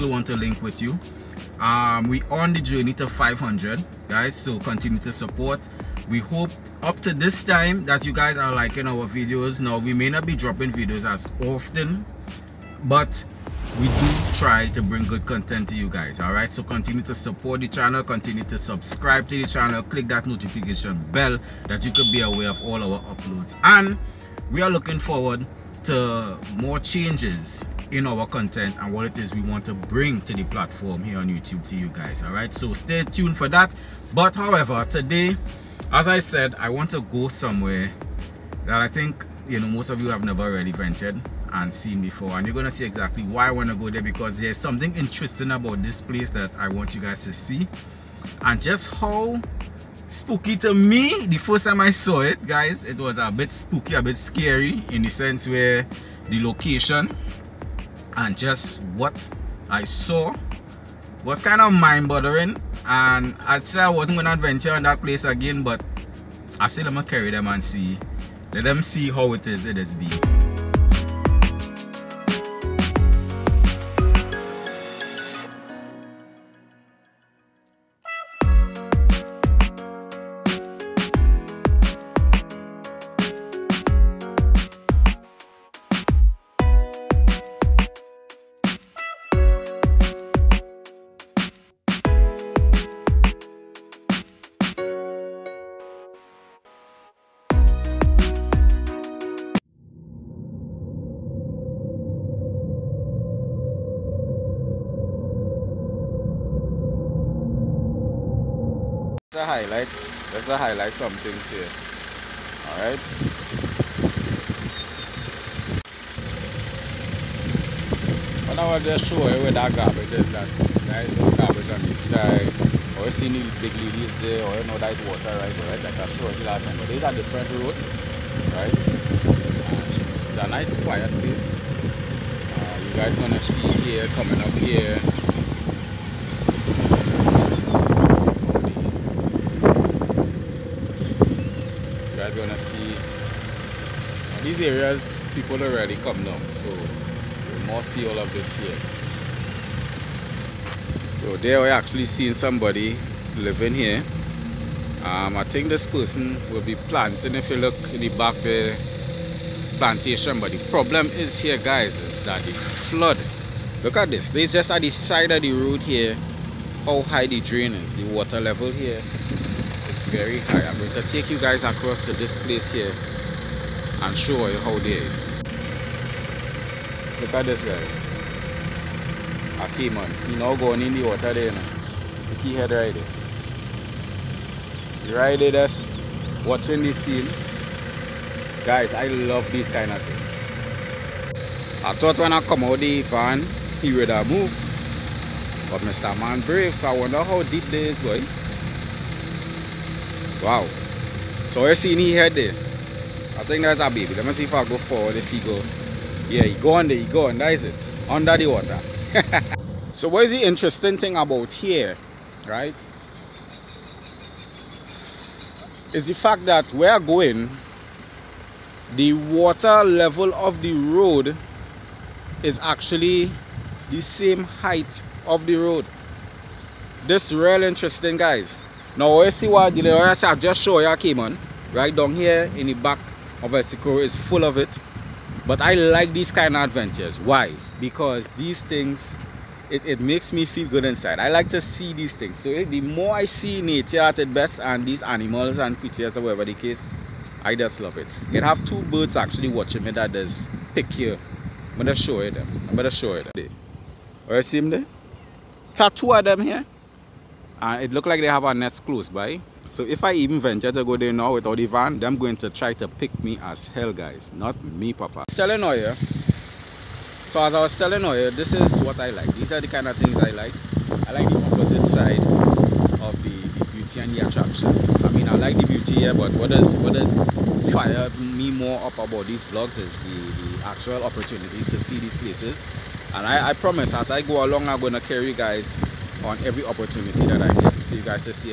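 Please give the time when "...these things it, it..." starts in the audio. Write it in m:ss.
3:58.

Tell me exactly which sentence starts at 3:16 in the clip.
Man Brave, So I wonder how deep this is, boy.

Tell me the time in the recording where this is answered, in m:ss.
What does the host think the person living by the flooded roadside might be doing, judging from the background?
2:39.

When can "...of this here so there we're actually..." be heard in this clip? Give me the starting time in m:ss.
2:28.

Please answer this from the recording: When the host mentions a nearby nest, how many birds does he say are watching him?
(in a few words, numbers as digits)
2.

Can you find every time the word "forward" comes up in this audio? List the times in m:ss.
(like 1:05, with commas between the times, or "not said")
0:24, 3:24.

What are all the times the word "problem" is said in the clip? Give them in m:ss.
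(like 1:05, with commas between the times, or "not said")
2:40.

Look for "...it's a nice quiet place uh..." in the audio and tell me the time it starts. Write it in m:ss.
2:10.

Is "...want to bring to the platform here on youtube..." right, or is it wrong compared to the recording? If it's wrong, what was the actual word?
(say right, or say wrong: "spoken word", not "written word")
right.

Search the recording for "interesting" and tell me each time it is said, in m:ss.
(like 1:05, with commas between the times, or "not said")
0:44, 3:30, 3:47.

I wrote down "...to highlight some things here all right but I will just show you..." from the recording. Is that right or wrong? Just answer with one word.
right.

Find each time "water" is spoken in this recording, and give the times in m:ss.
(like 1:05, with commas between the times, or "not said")
2:05, 2:48, 3:01, 3:28, 3:39.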